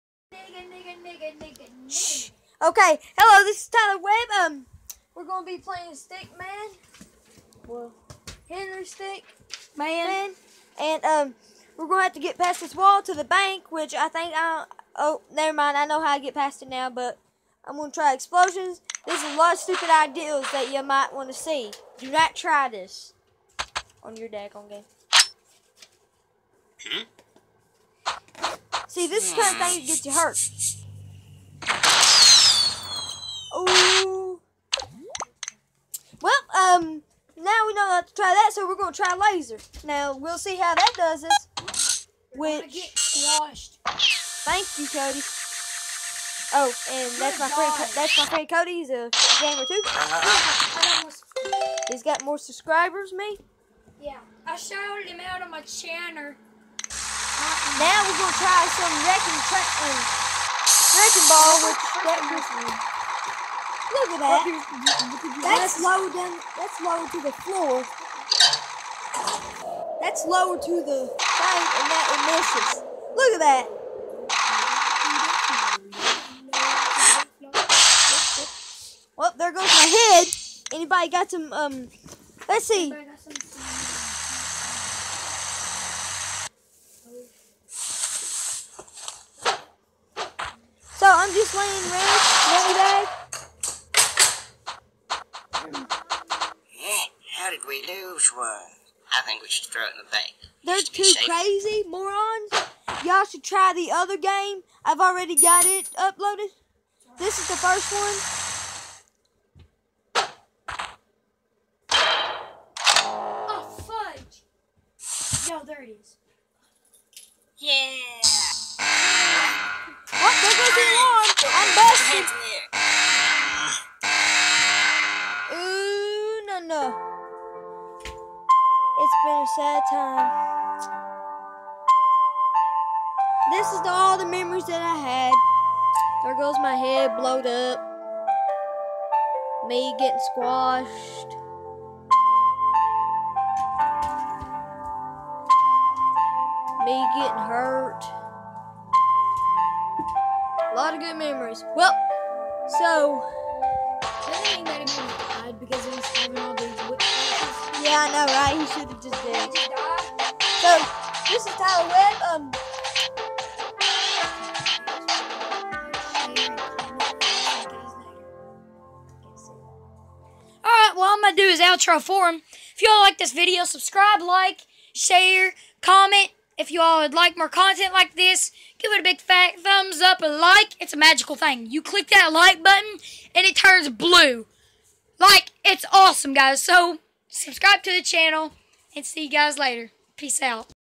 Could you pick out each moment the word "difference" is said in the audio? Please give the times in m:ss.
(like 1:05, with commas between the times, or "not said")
not said.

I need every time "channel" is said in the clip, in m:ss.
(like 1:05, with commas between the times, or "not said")
0:55, 3:08.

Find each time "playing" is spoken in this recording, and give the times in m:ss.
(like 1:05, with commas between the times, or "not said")
0:05, 1:31.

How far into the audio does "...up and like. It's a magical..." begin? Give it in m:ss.
3:00.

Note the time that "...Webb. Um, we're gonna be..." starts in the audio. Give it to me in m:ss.
0:03.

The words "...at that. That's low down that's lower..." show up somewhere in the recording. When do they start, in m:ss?
1:04.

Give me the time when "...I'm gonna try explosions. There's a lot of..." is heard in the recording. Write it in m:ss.
0:17.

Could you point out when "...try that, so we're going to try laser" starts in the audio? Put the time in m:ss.
0:38.